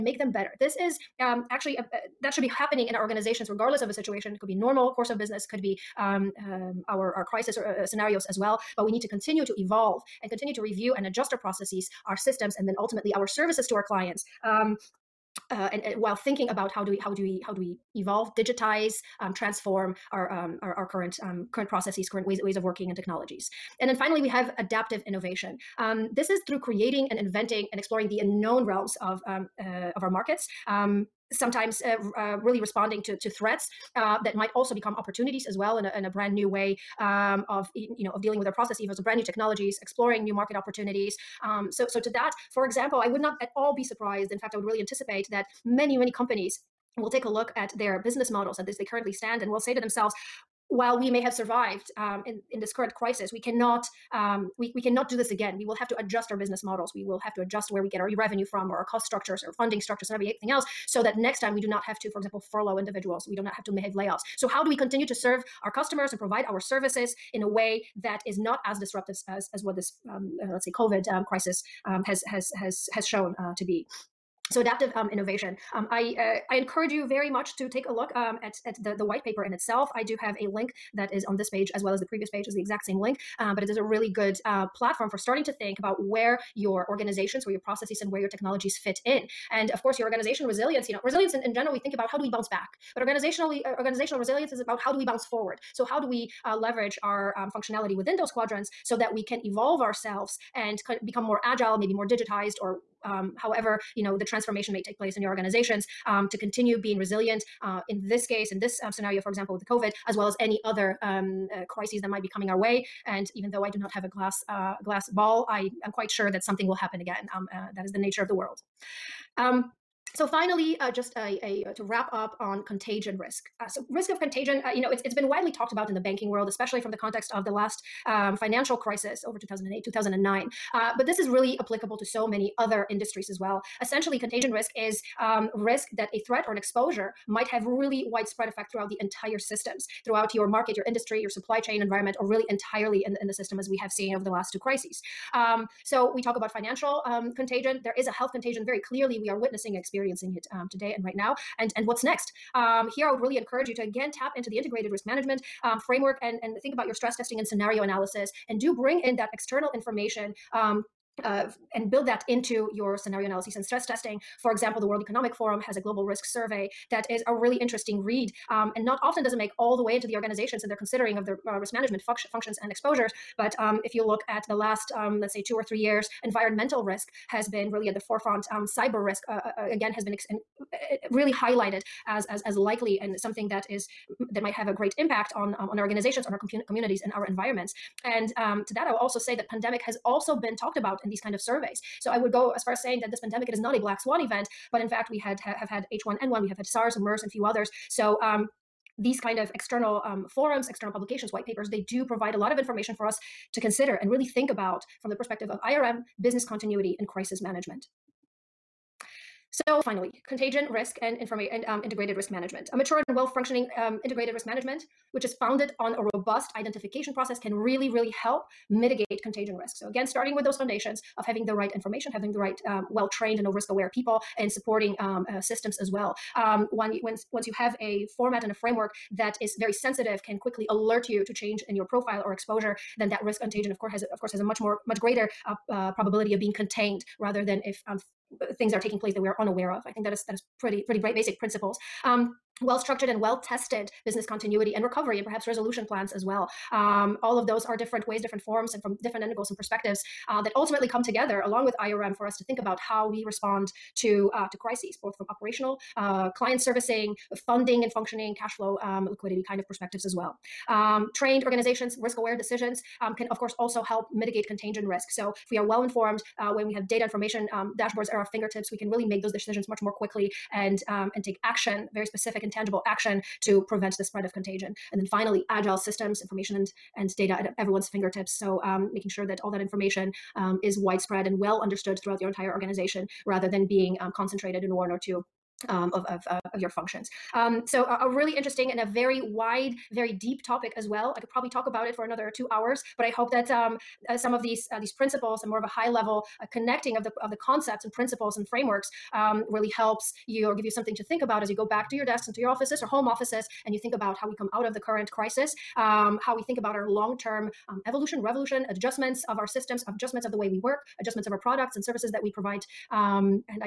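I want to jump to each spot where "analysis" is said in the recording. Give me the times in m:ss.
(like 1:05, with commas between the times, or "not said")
2:37, 2:43.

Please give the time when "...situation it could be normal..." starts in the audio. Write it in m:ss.
0:03.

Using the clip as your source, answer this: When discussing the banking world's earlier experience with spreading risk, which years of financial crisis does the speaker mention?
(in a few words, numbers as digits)
2008, 2009.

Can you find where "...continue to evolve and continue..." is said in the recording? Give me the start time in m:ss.
0:09.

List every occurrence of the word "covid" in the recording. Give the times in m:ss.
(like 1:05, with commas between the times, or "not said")
1:10, 1:49.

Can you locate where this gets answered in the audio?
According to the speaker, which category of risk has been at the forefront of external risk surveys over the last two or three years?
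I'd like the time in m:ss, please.
2:56.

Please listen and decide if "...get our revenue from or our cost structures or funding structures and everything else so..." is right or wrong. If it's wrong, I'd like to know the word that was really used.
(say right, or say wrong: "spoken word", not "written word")
right.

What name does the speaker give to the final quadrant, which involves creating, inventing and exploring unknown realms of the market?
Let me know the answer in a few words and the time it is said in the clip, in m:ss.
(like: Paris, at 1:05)
adaptive innovation, at 0:24.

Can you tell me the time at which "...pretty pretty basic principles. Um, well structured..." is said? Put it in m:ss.
4:00.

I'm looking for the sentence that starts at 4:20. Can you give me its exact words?
Um, trained organizations, risk aware decisions um, can, of course, also help mitigate contagion risk.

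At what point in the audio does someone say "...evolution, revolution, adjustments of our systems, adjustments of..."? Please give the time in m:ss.
5:07.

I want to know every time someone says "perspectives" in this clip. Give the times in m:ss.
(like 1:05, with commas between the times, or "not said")
3:25, 4:09, 4:19.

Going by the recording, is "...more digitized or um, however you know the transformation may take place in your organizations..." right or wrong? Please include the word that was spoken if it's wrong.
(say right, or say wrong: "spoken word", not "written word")
right.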